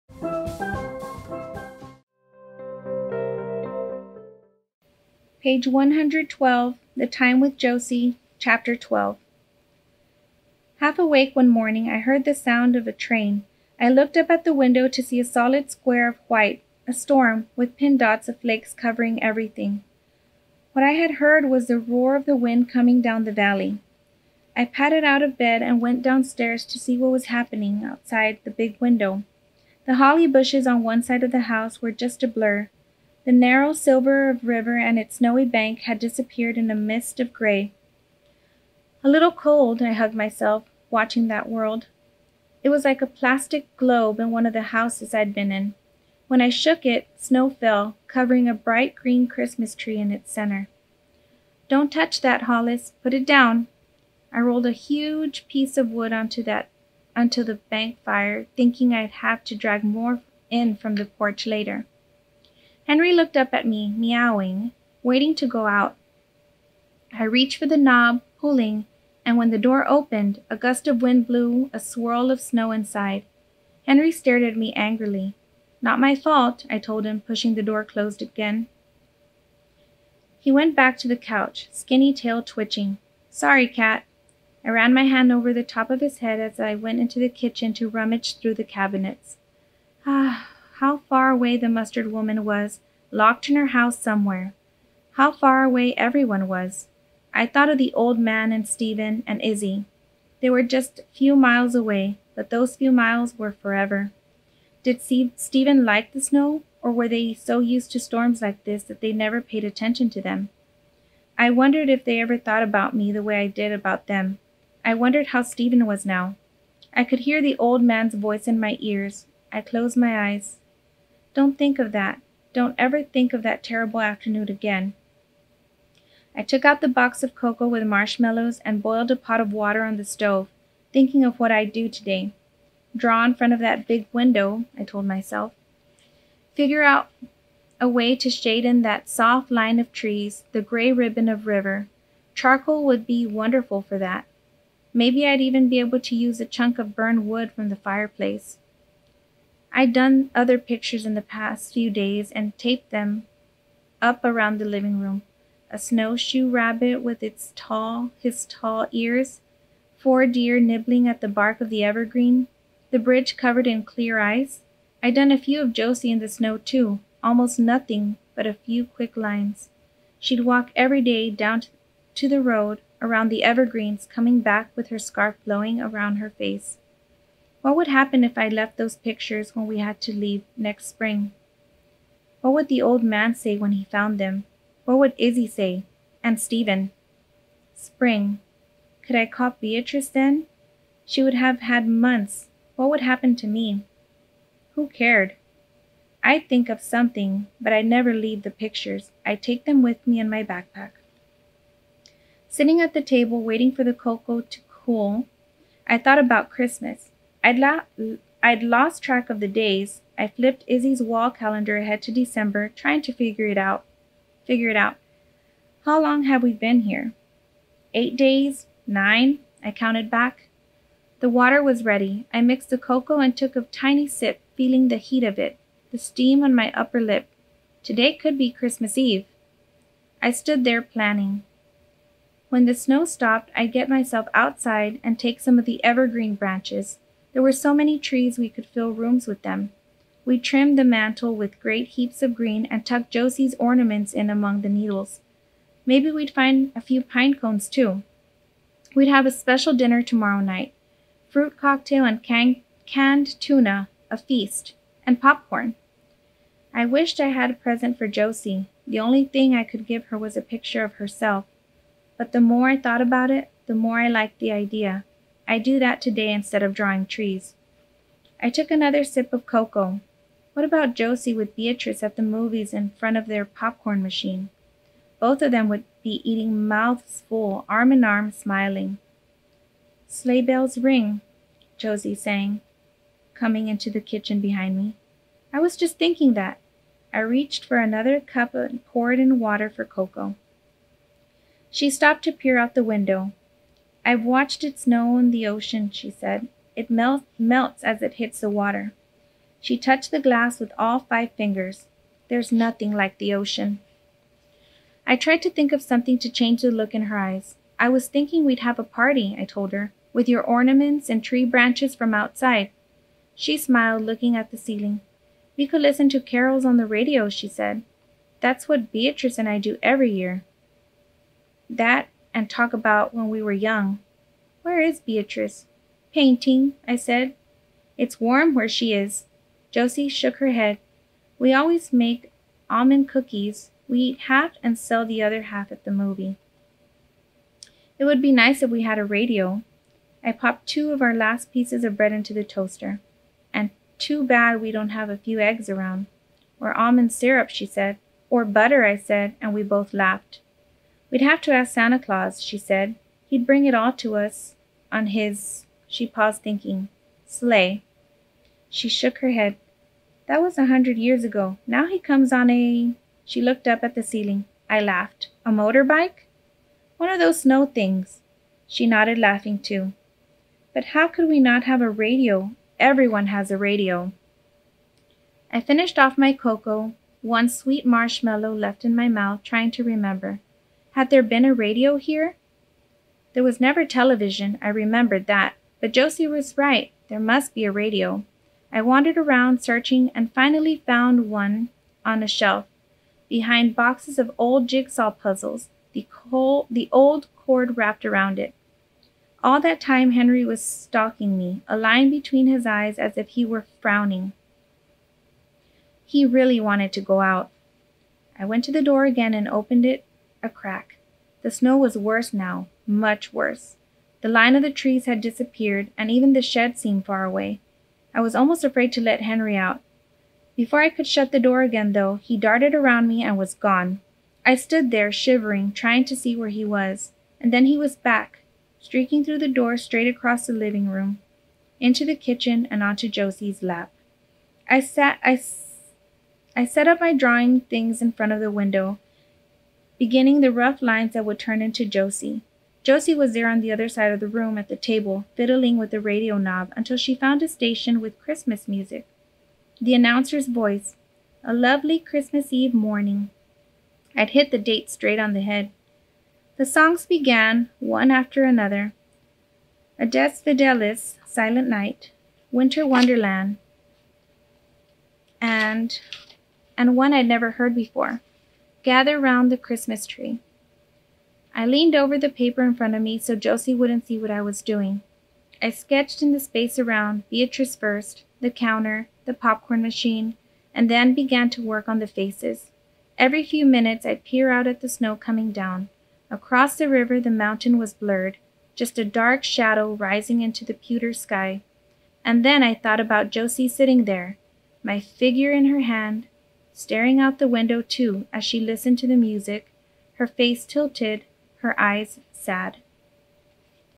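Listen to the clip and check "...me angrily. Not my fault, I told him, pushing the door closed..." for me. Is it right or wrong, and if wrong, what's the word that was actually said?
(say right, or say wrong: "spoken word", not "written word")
right.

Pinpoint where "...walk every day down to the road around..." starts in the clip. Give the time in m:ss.
2:50.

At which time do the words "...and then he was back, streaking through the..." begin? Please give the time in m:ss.
7:07.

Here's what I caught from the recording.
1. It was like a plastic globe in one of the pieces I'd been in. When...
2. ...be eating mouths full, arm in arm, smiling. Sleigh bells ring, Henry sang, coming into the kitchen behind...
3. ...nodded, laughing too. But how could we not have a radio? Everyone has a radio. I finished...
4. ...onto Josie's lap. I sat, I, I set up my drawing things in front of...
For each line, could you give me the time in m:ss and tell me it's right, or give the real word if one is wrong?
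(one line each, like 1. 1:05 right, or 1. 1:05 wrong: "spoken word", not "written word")
1. 0:42 wrong: "houses", not "pieces"
2. 4:36 wrong: "Josie", not "Henry"
3. 6:08 right
4. 7:12 right.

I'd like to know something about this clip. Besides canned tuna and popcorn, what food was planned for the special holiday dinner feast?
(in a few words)
Fruit cocktail.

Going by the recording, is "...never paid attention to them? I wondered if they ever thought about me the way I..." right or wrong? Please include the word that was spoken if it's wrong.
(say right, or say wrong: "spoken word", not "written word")
right.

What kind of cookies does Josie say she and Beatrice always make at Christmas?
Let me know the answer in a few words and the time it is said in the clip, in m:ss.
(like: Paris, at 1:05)
almond cookies, at 5:32.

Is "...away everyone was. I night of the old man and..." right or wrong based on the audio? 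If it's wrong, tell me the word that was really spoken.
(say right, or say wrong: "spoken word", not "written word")
wrong: "thought", not "night".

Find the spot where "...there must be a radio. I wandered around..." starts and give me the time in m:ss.
6:27.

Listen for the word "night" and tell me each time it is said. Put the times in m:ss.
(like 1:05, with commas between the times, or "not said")
4:10, 7:41.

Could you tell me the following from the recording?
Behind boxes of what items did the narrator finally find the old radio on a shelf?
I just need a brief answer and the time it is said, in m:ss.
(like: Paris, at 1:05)
old jigsaw puzzles, at 6:34.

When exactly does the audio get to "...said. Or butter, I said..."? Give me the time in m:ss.
5:47.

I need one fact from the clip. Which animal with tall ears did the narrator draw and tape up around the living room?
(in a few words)
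snowshoe rabbit.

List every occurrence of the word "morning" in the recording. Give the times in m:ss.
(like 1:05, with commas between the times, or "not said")
0:11, 7:32.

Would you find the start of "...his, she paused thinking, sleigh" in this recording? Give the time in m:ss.
5:55.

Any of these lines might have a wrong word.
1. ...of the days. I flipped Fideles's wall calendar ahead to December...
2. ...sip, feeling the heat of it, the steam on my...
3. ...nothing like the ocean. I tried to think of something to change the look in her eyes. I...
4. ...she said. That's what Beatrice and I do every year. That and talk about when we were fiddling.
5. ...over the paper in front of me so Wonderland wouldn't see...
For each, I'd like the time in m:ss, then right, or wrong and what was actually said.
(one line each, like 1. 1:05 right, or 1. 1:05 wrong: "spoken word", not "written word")
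1. 3:29 wrong: "Izzy", not "Fideles"
2. 3:44 right
3. 5:02 right
4. 5:17 wrong: "young", not "fiddling"
5. 7:51 wrong: "Josie", not "Wonderland".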